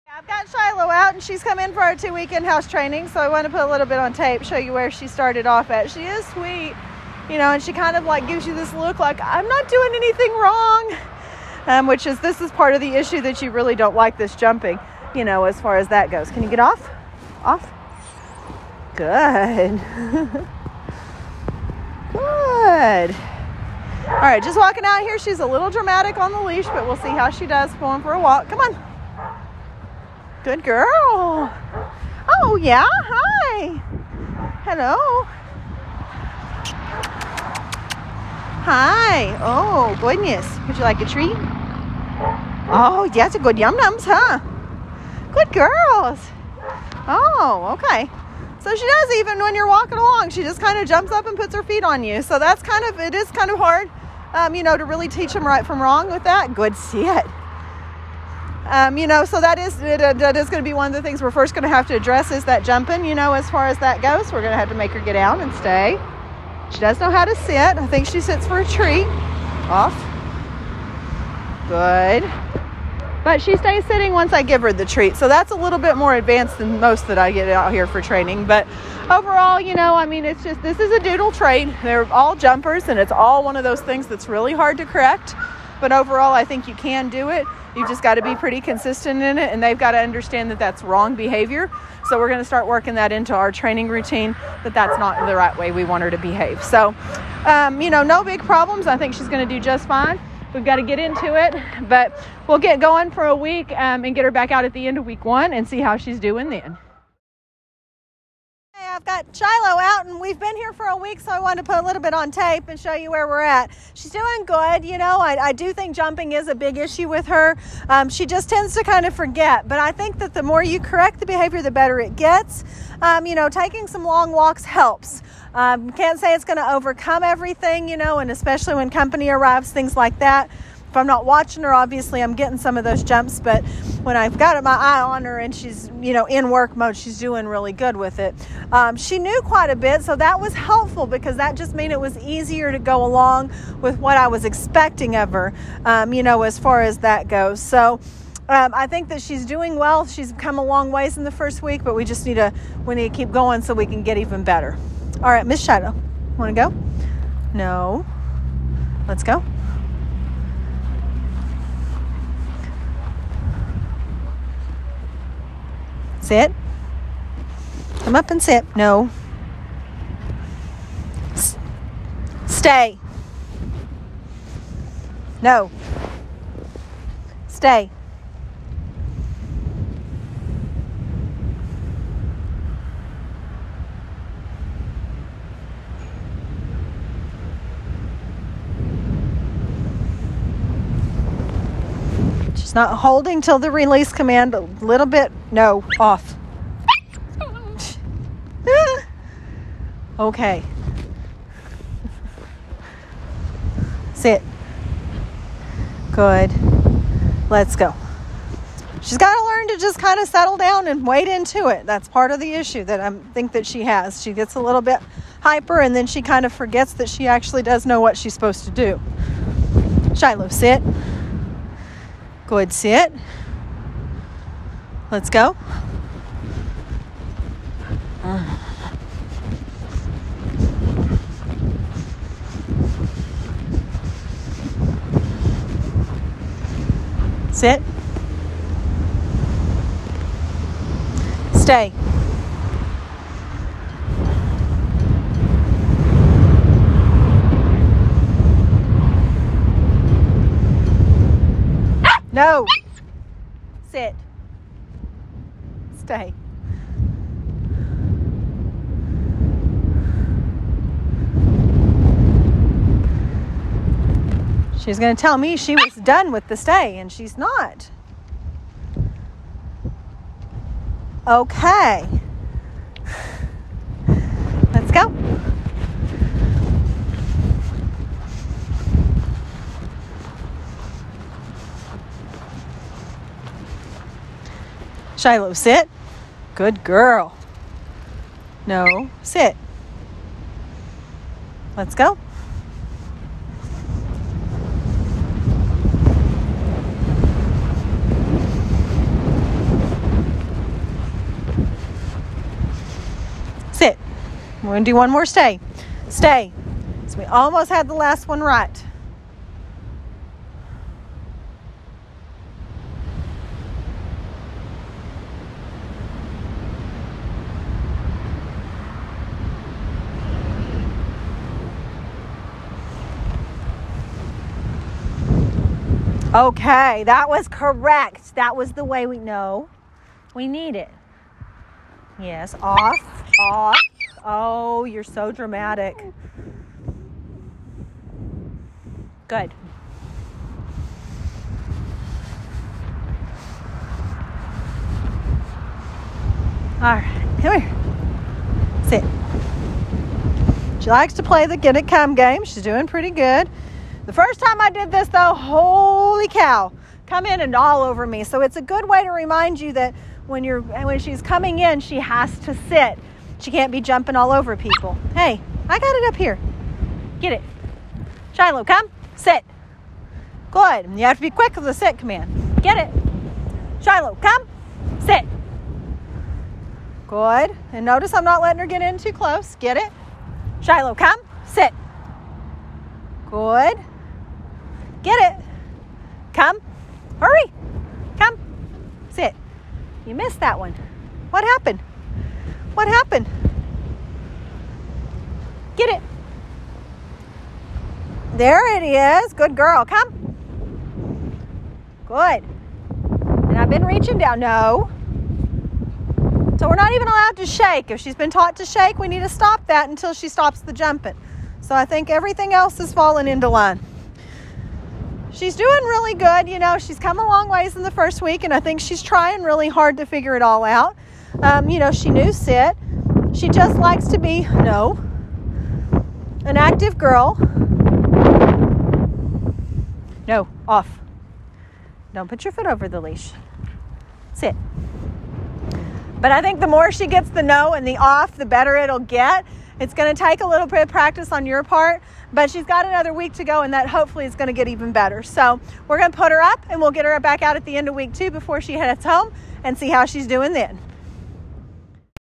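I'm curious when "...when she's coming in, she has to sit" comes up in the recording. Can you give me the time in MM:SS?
06:00.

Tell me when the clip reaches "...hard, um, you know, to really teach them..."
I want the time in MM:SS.
00:53.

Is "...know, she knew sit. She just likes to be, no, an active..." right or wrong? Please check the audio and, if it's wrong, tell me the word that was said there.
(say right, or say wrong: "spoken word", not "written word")
right.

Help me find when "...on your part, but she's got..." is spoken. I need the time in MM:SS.
07:21.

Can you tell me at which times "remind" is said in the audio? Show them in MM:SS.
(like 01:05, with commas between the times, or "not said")
05:59.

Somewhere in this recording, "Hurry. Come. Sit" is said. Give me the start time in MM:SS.
06:27.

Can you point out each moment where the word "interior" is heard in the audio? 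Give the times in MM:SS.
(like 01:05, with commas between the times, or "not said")
not said.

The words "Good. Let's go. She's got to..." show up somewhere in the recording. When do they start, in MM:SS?
03:26.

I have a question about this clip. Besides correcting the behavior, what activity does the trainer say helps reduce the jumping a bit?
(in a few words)
Long walks.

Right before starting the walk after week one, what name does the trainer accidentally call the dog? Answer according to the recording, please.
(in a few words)
Shadow.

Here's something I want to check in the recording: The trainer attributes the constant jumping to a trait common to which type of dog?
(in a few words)
Doodle.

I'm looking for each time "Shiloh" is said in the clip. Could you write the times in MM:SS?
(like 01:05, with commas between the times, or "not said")
00:00, 01:49, 03:40, 04:45, 06:08, 06:13, 06:20.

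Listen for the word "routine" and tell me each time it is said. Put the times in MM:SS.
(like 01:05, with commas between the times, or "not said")
01:33.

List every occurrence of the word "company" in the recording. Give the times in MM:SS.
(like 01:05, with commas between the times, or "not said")
02:08.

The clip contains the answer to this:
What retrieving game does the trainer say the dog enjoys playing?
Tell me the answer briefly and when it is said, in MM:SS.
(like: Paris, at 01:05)
Get it come game, at 05:51.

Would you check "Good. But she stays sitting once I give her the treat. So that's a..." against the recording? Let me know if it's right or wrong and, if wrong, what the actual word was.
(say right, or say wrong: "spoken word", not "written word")
right.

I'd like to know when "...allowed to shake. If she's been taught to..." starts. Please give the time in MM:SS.
06:47.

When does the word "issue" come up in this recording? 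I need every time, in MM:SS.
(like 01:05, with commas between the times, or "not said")
00:12, 01:56, 03:32.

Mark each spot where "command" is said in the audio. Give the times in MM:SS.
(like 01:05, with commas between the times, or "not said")
03:14, 06:11.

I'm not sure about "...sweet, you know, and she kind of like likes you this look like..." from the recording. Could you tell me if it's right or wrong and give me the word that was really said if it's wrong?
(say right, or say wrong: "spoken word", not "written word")
wrong: "gives", not "likes".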